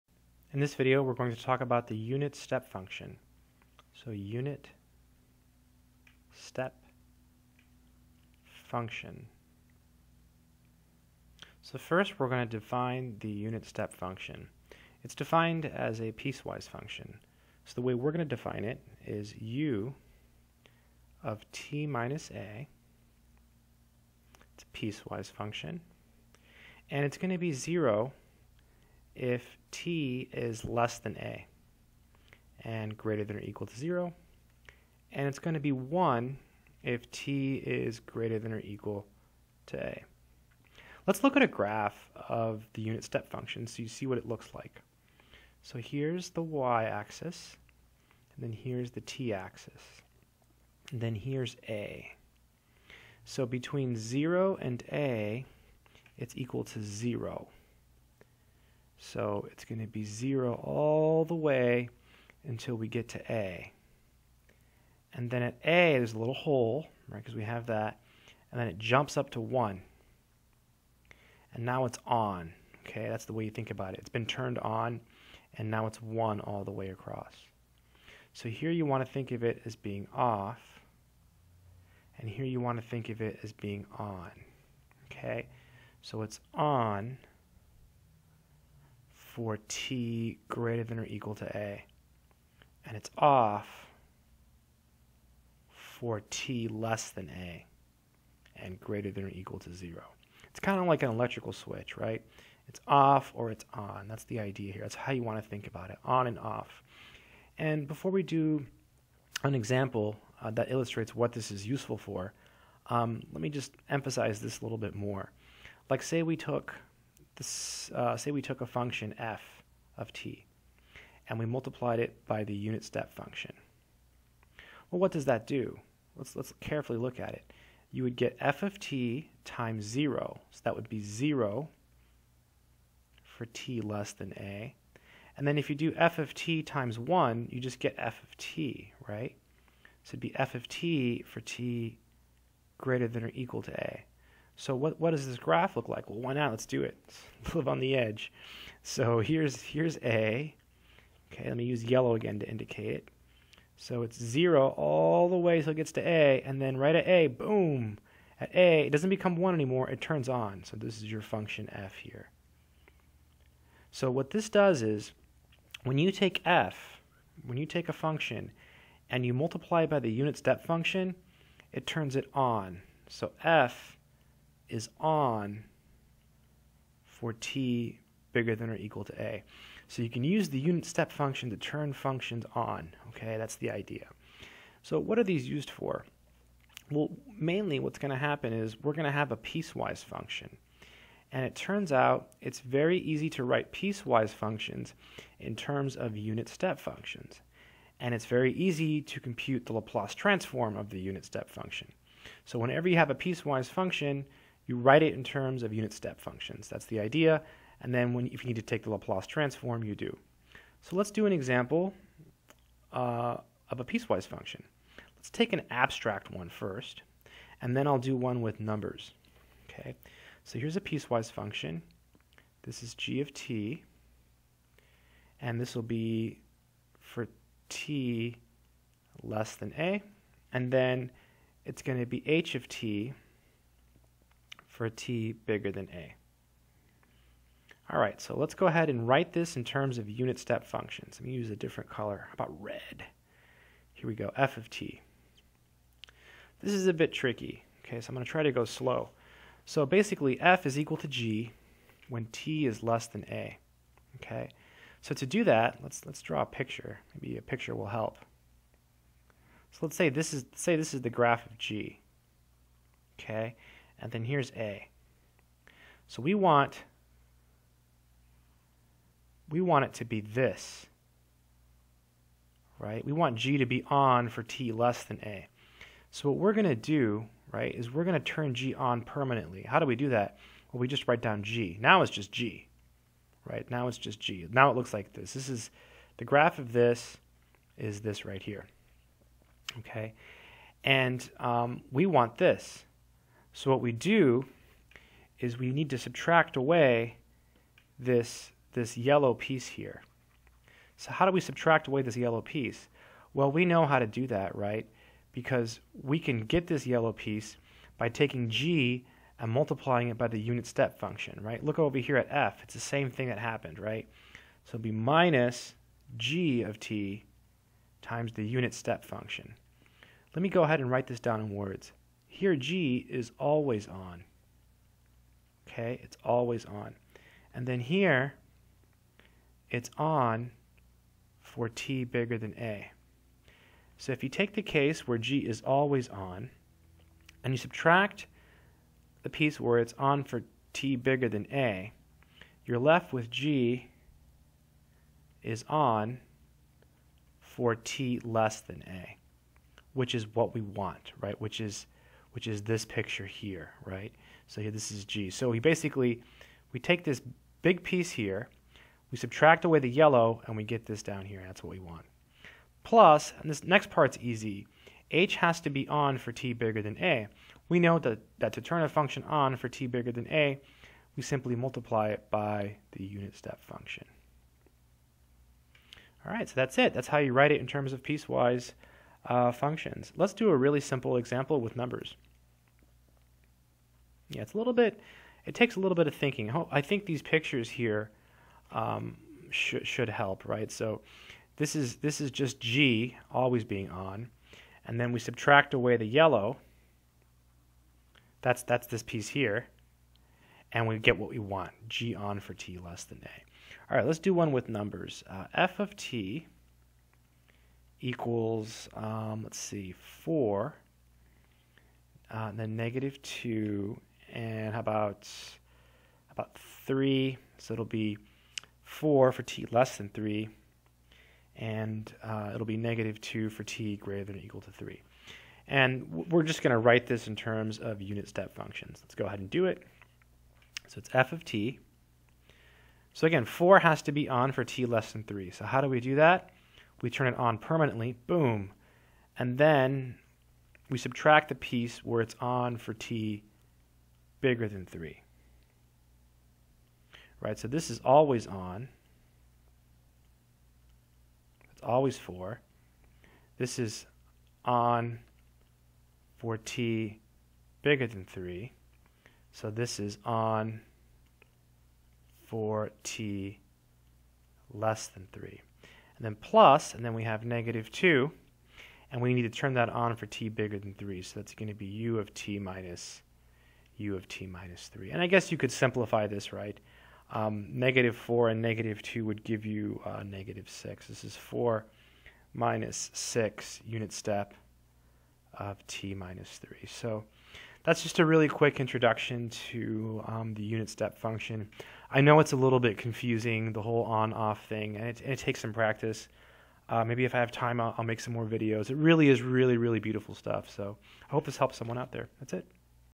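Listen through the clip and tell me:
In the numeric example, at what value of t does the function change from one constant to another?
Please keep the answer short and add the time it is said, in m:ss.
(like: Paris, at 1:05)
3, at 7:03.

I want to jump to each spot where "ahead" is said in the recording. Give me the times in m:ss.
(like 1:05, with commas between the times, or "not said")
3:58, 5:20, 7:09.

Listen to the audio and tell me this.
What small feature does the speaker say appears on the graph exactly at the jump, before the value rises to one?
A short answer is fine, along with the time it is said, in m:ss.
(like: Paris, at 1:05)
a little hole, at 1:06.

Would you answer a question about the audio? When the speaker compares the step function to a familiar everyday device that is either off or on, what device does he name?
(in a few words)
electrical switch.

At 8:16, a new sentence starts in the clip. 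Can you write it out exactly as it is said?
Uh, maybe if I have time, I'll, I'll make some more videos.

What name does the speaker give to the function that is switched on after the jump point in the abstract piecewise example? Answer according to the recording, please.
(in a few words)
h of t.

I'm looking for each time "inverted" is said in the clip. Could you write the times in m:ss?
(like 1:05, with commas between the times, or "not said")
not said.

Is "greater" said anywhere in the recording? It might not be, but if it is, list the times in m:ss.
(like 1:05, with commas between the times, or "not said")
0:32, 0:37, 1:30, 1:38, 2:22, 7:03.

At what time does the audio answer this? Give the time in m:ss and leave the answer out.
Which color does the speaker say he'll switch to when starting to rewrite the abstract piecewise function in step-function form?
4:02.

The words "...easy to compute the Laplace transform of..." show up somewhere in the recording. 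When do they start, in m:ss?
3:18.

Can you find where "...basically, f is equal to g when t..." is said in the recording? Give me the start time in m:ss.
4:09.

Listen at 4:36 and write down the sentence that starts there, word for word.
So what we're going to do, right, is we're going to turn G on permanently.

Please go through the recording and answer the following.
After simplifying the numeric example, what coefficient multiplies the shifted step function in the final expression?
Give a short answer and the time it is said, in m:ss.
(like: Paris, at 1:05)
-6, at 8:00.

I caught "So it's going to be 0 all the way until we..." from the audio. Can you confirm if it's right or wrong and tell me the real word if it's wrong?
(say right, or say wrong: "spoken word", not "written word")
right.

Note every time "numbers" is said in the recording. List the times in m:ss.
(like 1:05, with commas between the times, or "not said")
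3:38, 6:21, 6:44.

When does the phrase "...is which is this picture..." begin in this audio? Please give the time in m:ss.
5:51.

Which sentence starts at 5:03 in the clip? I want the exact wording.
Well, we know how to do that, right?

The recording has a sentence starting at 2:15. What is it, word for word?
And then if you do f of t times 1, you just get f of t, right?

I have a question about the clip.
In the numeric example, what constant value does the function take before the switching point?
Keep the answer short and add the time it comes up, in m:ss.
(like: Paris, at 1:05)
4, at 6:58.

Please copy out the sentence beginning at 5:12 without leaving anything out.
It's the same thing that happened, right?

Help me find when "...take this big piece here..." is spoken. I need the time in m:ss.
5:56.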